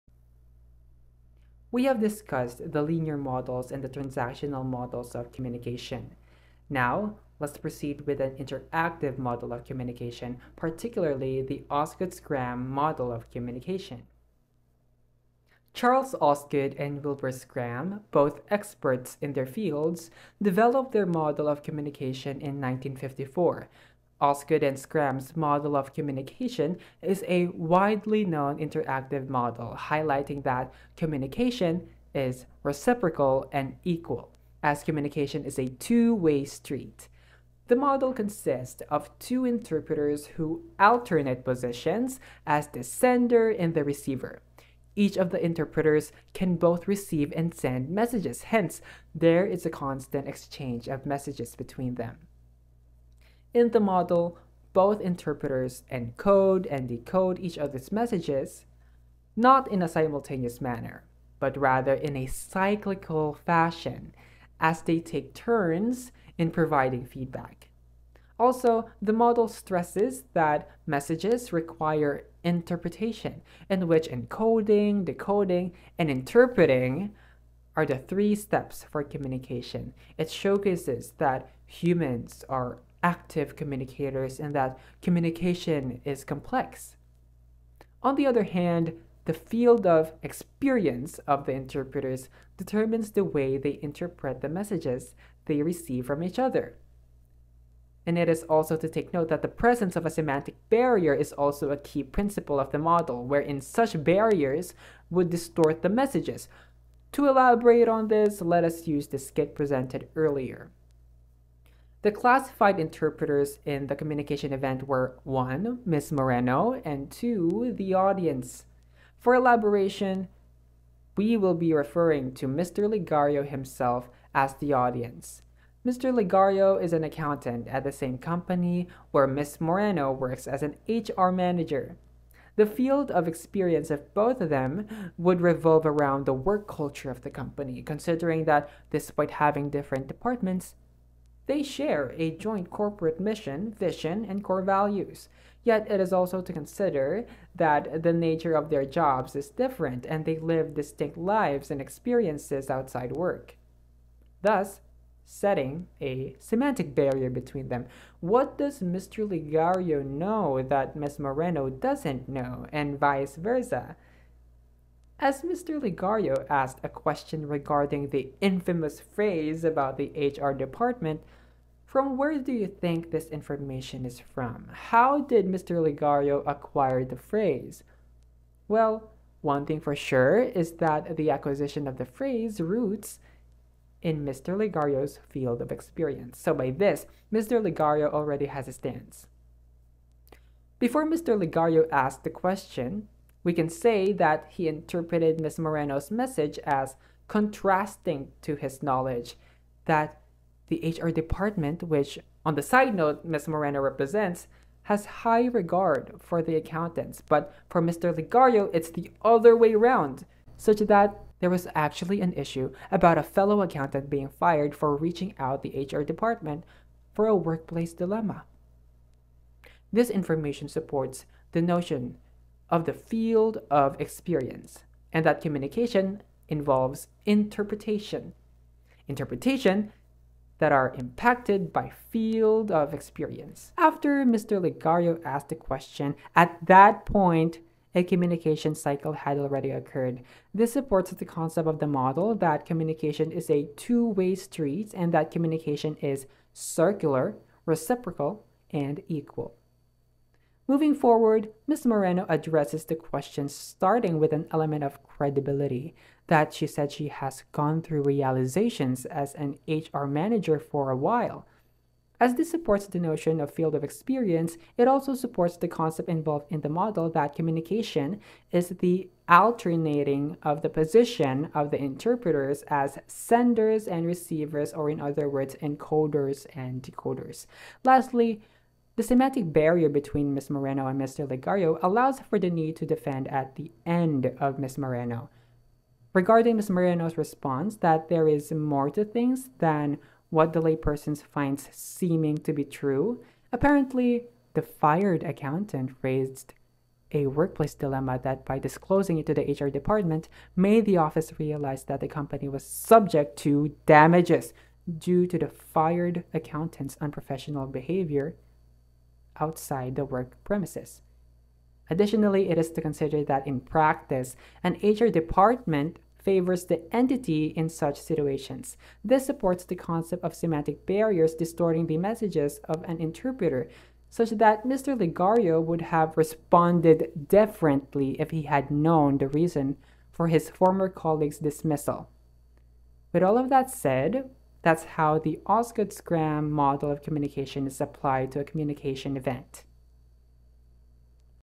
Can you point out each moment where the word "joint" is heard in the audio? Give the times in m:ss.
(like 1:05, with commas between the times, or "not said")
2:22.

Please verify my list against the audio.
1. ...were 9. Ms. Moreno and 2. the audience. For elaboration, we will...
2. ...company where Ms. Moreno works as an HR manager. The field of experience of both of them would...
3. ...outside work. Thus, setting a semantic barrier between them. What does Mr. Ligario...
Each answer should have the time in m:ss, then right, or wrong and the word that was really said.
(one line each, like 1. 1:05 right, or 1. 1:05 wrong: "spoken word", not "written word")
1. 1:54 wrong: "1", not "9"
2. 2:08 right
3. 2:32 right.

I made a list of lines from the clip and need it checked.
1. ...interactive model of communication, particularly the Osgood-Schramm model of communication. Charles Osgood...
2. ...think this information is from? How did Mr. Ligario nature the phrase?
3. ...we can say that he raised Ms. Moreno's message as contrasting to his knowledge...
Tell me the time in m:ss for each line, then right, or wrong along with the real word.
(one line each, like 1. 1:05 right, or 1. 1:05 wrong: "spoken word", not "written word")
1. 0:08 right
2. 2:52 wrong: "acquire", not "nature"
3. 3:13 wrong: "interpreted", not "raised".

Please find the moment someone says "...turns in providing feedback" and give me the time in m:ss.
1:05.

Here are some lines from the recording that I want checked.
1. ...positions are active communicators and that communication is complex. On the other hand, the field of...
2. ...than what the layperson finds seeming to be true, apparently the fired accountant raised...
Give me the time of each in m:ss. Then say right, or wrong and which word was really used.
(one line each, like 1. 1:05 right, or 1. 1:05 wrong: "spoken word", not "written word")
1. 1:21 wrong: "humans", not "positions"
2. 4:49 right.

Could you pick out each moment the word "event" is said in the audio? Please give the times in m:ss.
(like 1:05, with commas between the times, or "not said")
1:54, 5:39.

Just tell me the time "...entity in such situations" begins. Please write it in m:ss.
5:16.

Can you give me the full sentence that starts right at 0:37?
The model consists of two interpreters who alternate positions as the sender and the receiver.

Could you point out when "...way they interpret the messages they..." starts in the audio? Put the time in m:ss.
1:33.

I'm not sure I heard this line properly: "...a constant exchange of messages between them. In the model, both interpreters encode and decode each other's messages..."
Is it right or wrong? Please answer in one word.
right.